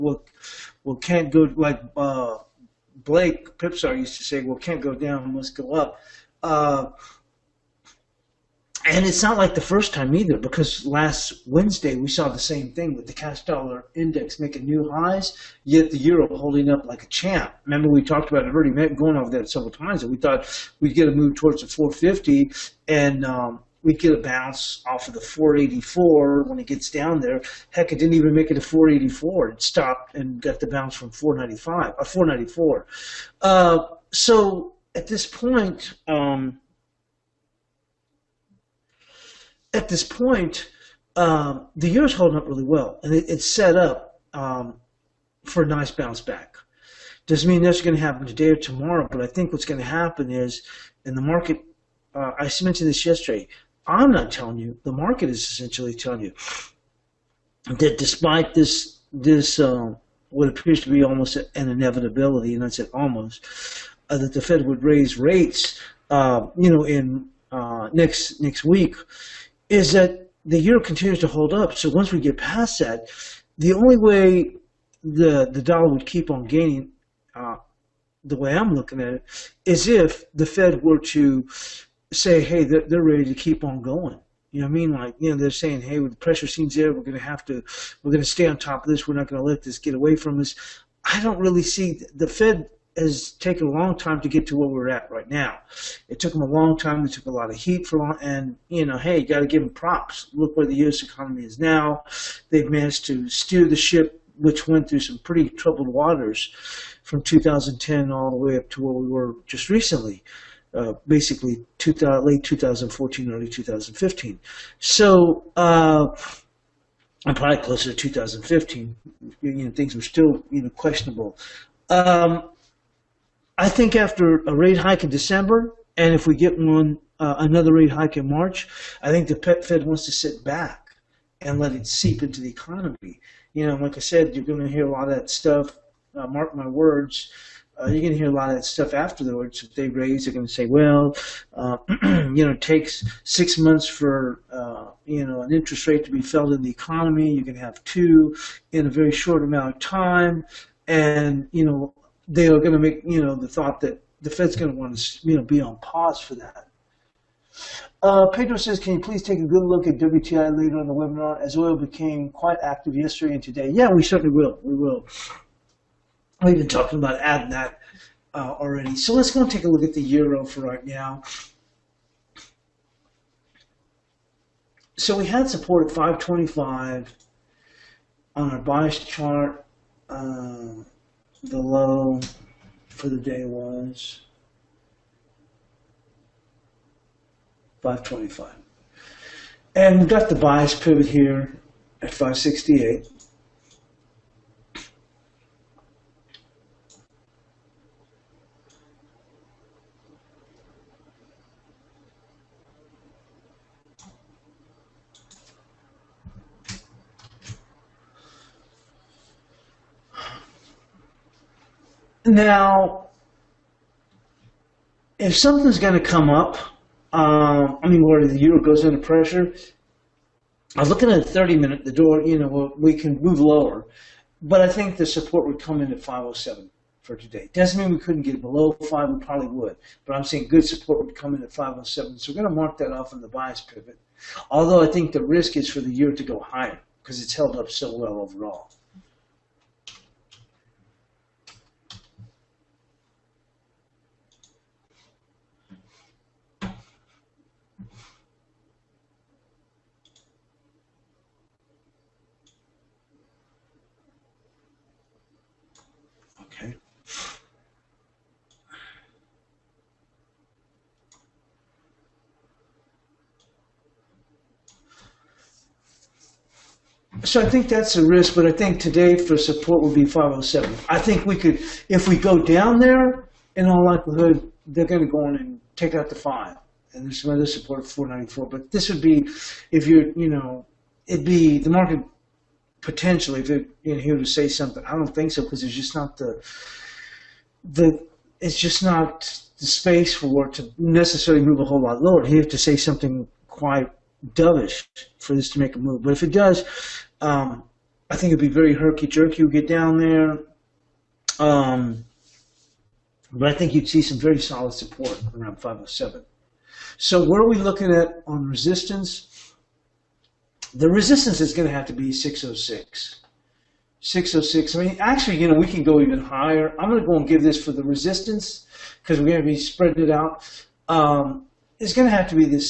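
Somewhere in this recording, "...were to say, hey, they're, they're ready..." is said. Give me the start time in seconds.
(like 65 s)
80 s.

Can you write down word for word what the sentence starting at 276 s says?
And there's some other support for 494.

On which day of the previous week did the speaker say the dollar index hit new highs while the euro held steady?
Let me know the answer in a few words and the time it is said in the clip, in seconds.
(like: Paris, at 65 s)
Wednesday, at 11 s.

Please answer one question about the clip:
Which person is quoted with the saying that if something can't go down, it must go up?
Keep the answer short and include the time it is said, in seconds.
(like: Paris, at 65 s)
Blake Pipsar, at 3 s.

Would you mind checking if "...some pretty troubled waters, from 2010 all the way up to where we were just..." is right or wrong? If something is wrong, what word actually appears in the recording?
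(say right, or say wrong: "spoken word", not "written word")
right.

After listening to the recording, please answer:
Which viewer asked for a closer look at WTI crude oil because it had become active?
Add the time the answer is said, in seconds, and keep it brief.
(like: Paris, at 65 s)
Pedro, at 158 s.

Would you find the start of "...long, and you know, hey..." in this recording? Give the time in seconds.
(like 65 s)
97 s.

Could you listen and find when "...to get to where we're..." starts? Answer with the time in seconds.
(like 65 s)
94 s.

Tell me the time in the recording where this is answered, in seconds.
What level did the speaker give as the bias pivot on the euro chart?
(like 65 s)
192 s.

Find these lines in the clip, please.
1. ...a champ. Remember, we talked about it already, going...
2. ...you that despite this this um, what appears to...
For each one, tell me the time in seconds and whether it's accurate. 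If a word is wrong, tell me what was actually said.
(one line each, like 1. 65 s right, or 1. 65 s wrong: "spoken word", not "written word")
1. 17 s right
2. 56 s right.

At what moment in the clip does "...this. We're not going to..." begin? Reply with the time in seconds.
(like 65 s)
88 s.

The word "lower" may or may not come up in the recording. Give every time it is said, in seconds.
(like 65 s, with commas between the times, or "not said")
223 s, 292 s.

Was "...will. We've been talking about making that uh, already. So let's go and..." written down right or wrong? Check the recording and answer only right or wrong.
wrong.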